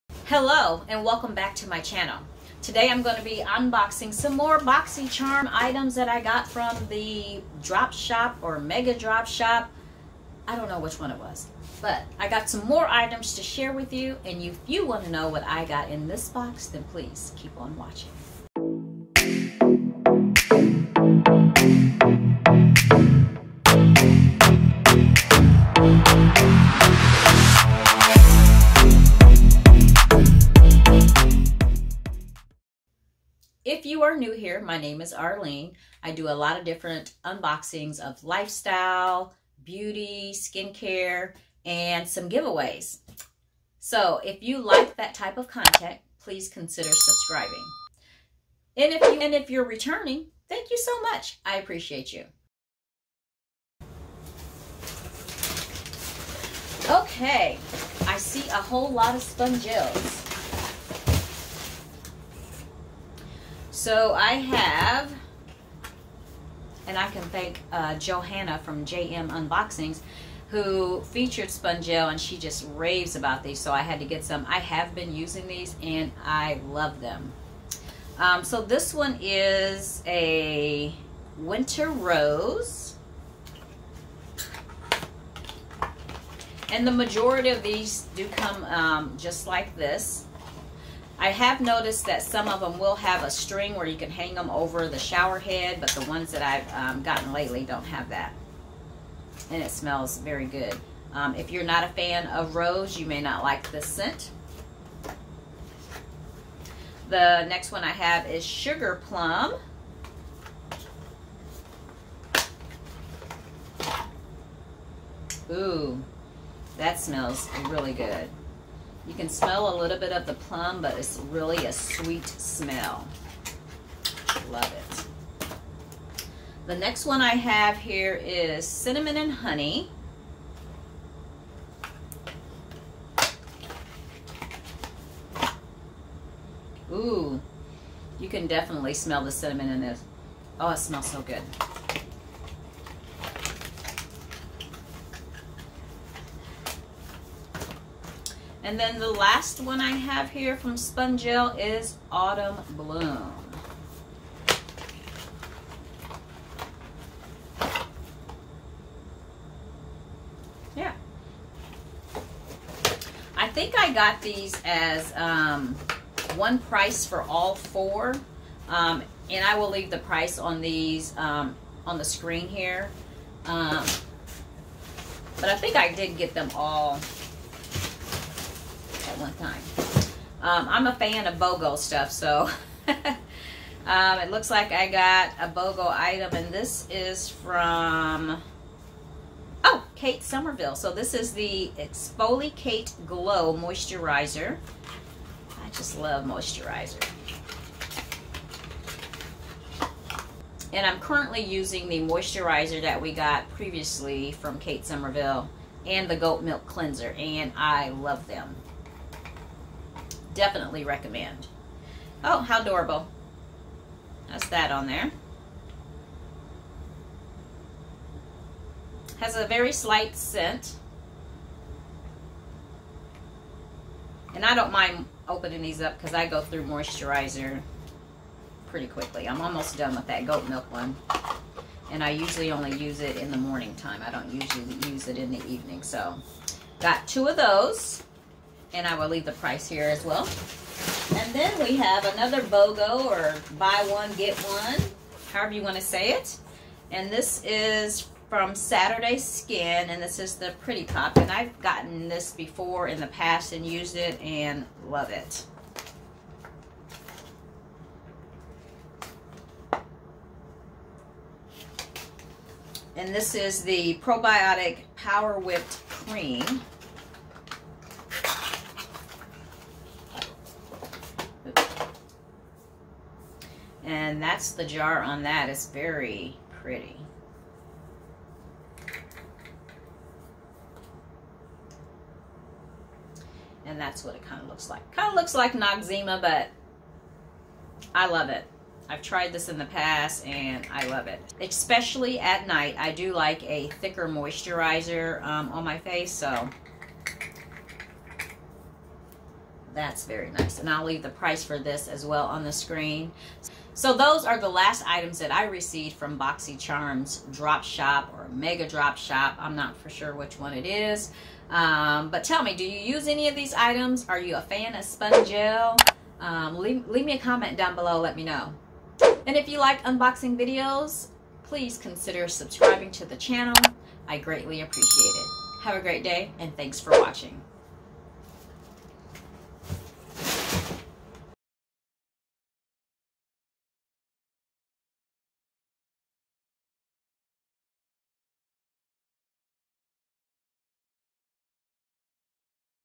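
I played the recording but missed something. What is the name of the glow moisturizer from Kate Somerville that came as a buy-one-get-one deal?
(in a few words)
ExfoliKate Glow Moisturizer.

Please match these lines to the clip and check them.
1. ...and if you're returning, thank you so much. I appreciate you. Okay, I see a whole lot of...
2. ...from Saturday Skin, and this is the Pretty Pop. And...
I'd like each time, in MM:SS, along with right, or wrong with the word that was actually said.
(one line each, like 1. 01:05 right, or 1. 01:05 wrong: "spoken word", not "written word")
1. 00:49 right
2. 04:08 right.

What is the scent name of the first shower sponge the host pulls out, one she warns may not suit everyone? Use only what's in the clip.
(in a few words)
Winter Rose.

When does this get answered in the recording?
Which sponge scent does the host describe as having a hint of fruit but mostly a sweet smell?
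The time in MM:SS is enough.
01:48.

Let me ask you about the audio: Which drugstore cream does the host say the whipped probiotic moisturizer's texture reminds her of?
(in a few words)
Noxzema.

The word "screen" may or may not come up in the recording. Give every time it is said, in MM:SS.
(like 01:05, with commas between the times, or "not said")
02:52, 05:02.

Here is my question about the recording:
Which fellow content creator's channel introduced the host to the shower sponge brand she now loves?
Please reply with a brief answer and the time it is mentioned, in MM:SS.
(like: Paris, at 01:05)
JM Unboxings, at 01:08.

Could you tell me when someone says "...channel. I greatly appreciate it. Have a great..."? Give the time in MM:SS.
05:23.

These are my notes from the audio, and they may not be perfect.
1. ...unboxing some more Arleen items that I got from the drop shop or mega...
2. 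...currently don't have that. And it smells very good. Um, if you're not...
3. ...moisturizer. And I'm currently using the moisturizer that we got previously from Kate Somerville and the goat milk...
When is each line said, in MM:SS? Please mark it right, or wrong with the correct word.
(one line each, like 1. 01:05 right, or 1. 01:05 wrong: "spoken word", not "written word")
1. 00:03 wrong: "BoxyCharm", not "Arleen"
2. 01:37 wrong: "lately", not "currently"
3. 03:16 right.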